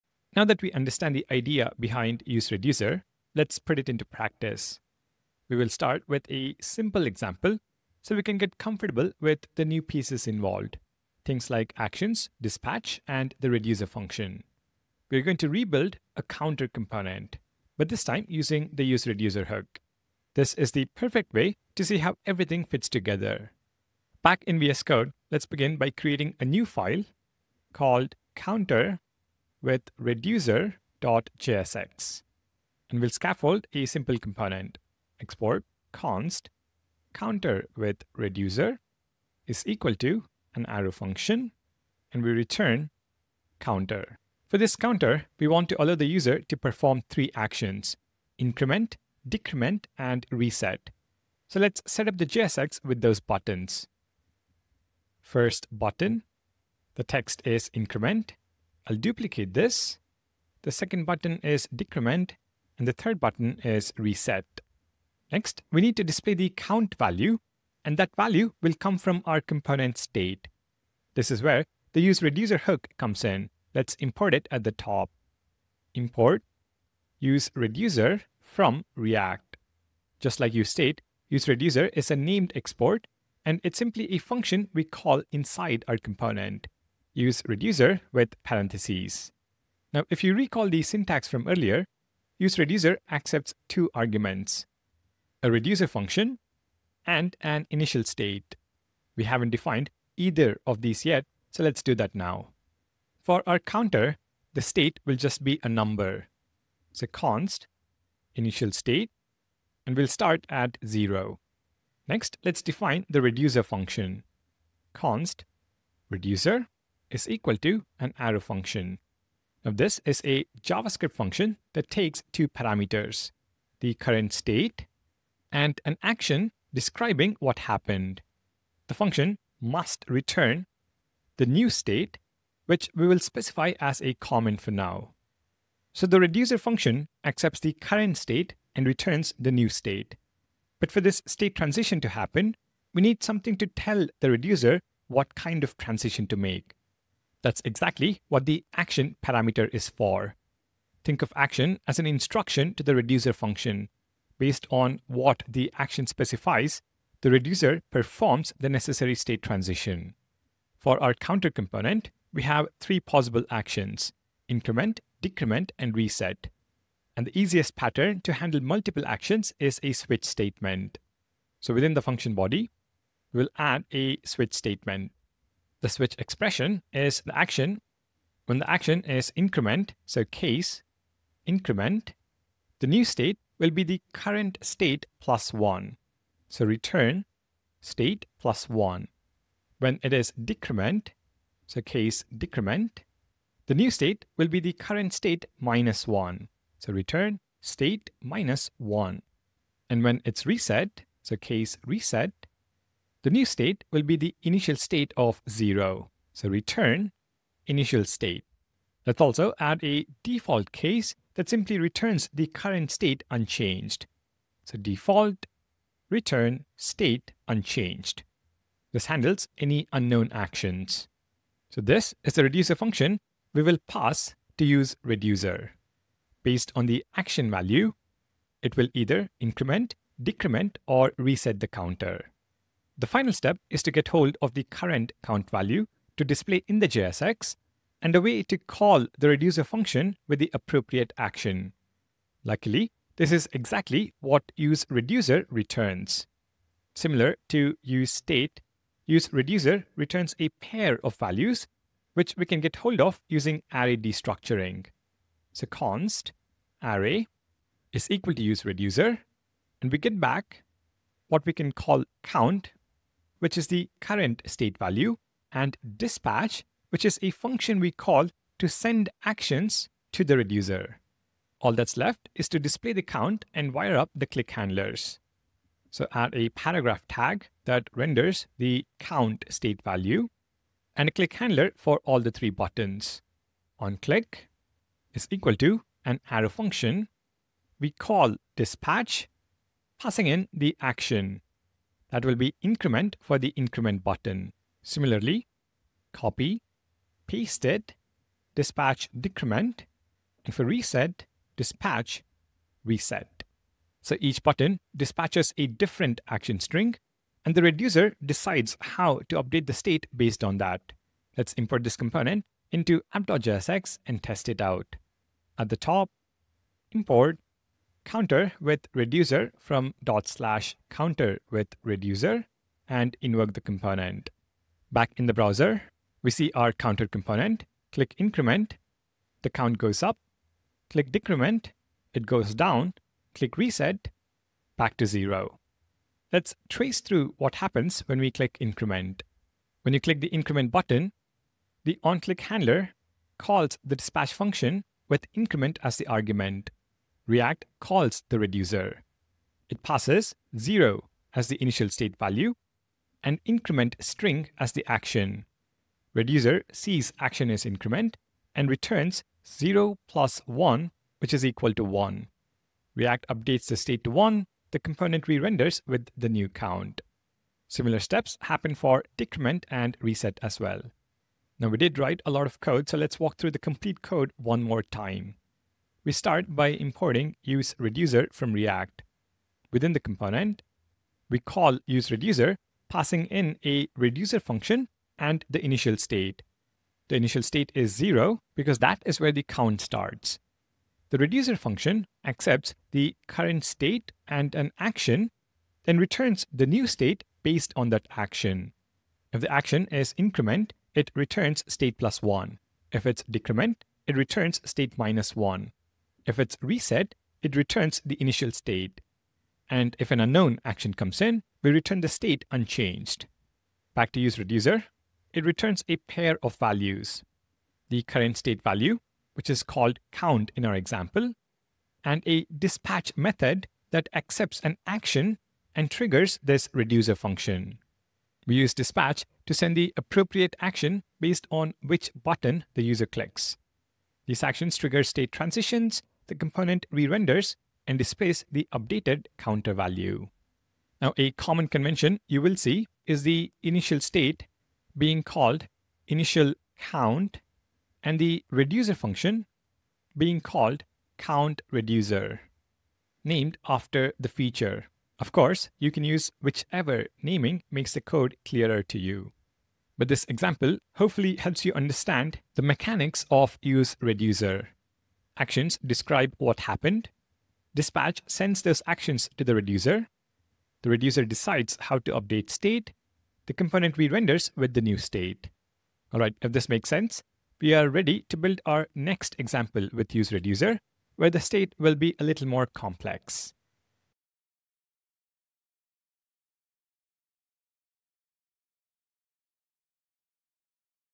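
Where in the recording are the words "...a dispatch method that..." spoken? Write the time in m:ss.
7:02.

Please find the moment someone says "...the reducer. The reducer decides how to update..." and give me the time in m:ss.
7:49.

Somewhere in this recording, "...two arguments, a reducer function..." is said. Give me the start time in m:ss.
1:33.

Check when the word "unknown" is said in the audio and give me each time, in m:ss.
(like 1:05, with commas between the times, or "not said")
3:39, 6:50.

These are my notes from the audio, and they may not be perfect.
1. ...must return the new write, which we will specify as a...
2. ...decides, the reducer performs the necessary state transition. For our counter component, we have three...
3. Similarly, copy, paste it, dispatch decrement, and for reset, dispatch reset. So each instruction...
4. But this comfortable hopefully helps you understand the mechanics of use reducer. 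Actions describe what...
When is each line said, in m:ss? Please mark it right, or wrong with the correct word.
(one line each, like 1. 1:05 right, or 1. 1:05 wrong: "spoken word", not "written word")
1. 2:09 wrong: "state", not "write"
2. 2:36 wrong: "specifies", not "decides"
3. 4:54 wrong: "button", not "instruction"
4. 7:39 wrong: "example", not "comfortable".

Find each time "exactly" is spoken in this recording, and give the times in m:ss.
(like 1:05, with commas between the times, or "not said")
2:27, 4:03.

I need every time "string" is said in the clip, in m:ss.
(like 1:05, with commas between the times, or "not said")
5:06, 5:54.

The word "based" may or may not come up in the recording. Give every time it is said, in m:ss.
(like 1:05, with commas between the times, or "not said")
2:34, 3:46, 5:10, 6:37, 7:11.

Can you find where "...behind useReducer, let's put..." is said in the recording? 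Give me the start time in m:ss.
0:01.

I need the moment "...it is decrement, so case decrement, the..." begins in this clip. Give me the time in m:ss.
3:10.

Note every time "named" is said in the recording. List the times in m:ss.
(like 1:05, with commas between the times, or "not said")
1:22, 7:33.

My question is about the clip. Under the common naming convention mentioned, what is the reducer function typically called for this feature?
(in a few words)
count reducer.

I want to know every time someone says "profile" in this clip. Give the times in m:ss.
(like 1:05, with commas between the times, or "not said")
not said.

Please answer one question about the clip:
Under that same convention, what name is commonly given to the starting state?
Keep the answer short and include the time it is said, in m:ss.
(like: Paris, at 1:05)
initial count, at 7:26.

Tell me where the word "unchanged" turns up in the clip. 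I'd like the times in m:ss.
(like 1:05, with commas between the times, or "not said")
3:33, 3:37, 6:52.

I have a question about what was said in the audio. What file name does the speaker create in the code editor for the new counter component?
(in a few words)
counter with reducer.jsx.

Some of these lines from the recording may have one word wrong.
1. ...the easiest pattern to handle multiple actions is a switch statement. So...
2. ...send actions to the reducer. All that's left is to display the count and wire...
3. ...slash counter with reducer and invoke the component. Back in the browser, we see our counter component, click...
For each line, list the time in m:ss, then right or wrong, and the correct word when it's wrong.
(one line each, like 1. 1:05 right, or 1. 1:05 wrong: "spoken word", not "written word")
1. 2:47 right
2. 4:28 right
3. 5:20 right.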